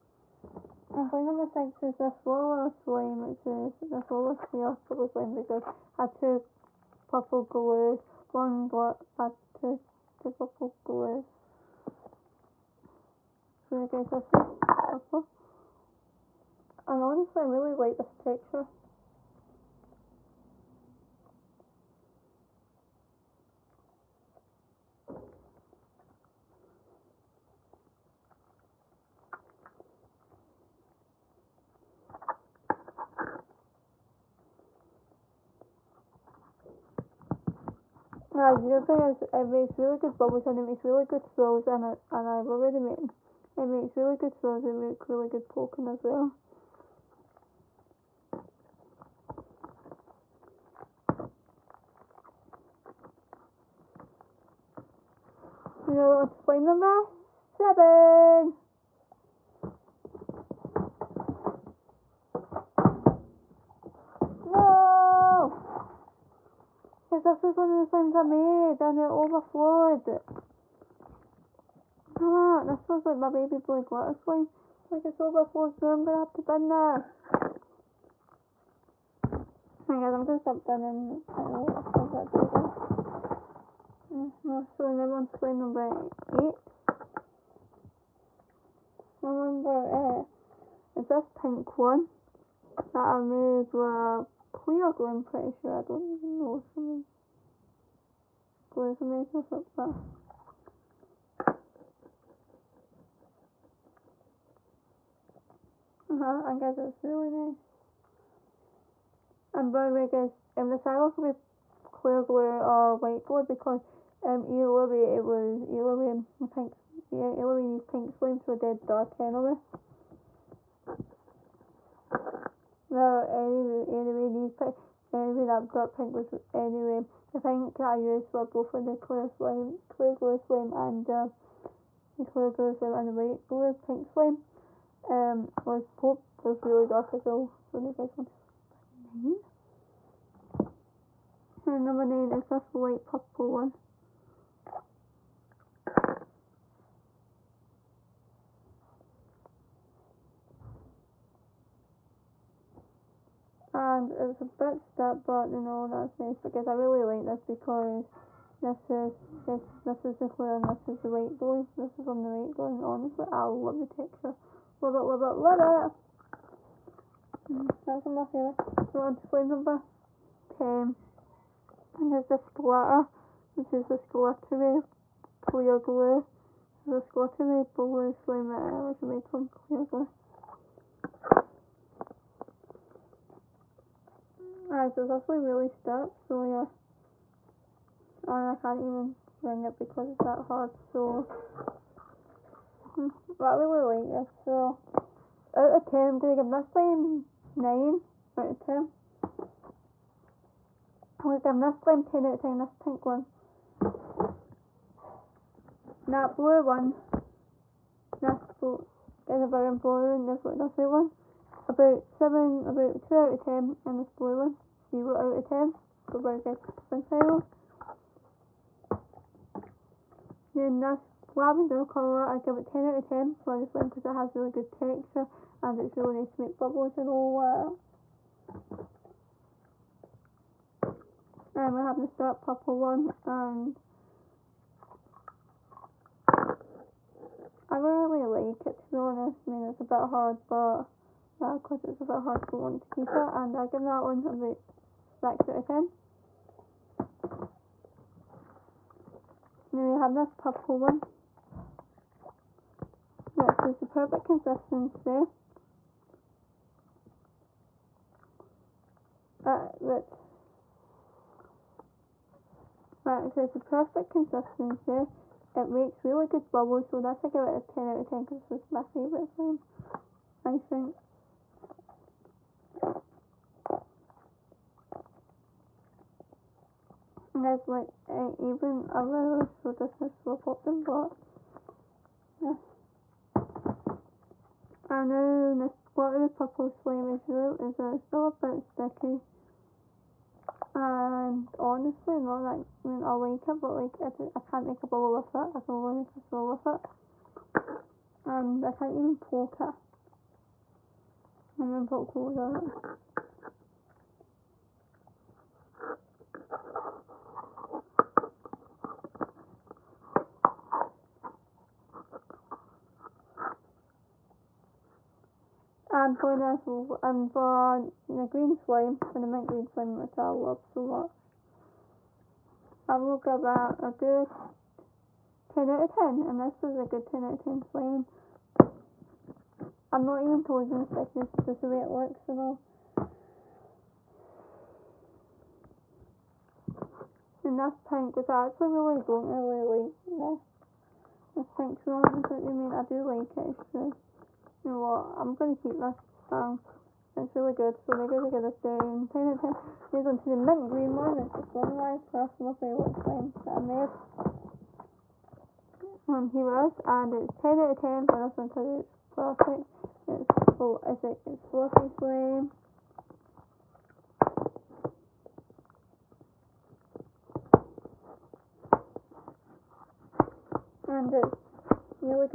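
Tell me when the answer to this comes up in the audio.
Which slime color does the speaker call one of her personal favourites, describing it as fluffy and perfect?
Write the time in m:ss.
5:50.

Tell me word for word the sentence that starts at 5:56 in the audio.
And here it is, and it's 10 out of 10 for this one because it's perfect.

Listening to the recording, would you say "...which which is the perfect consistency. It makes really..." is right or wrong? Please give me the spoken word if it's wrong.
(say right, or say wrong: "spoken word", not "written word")
right.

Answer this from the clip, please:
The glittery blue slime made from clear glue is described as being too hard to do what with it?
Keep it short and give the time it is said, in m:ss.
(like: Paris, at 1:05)
string it, at 3:09.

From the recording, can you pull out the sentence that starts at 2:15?
Um, was pop was really dark as well.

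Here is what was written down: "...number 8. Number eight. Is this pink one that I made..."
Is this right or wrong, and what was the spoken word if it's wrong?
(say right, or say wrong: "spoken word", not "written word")
right.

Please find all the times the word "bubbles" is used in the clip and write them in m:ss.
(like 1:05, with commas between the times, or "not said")
0:40, 3:46, 4:26, 4:54.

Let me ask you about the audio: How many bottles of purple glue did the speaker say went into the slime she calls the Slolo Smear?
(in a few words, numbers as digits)
2.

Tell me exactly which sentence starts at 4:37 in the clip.
guys, like, even I really should this is for popping, but yeah.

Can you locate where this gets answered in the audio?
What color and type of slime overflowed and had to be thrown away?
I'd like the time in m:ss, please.
1:13.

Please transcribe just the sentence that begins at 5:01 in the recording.
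I'm gonna put clothes on it.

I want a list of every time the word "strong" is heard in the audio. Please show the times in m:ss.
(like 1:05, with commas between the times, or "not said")
not said.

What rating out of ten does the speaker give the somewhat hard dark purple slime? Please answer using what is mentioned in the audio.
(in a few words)
6.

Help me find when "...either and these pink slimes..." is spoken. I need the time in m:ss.
1:57.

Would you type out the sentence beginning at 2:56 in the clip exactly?
This glittery blue slime which is made from clear glue.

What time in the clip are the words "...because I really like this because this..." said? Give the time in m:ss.
2:36.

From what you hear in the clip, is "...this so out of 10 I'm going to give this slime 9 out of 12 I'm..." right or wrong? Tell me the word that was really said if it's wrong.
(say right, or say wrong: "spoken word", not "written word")
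wrong: "10", not "12".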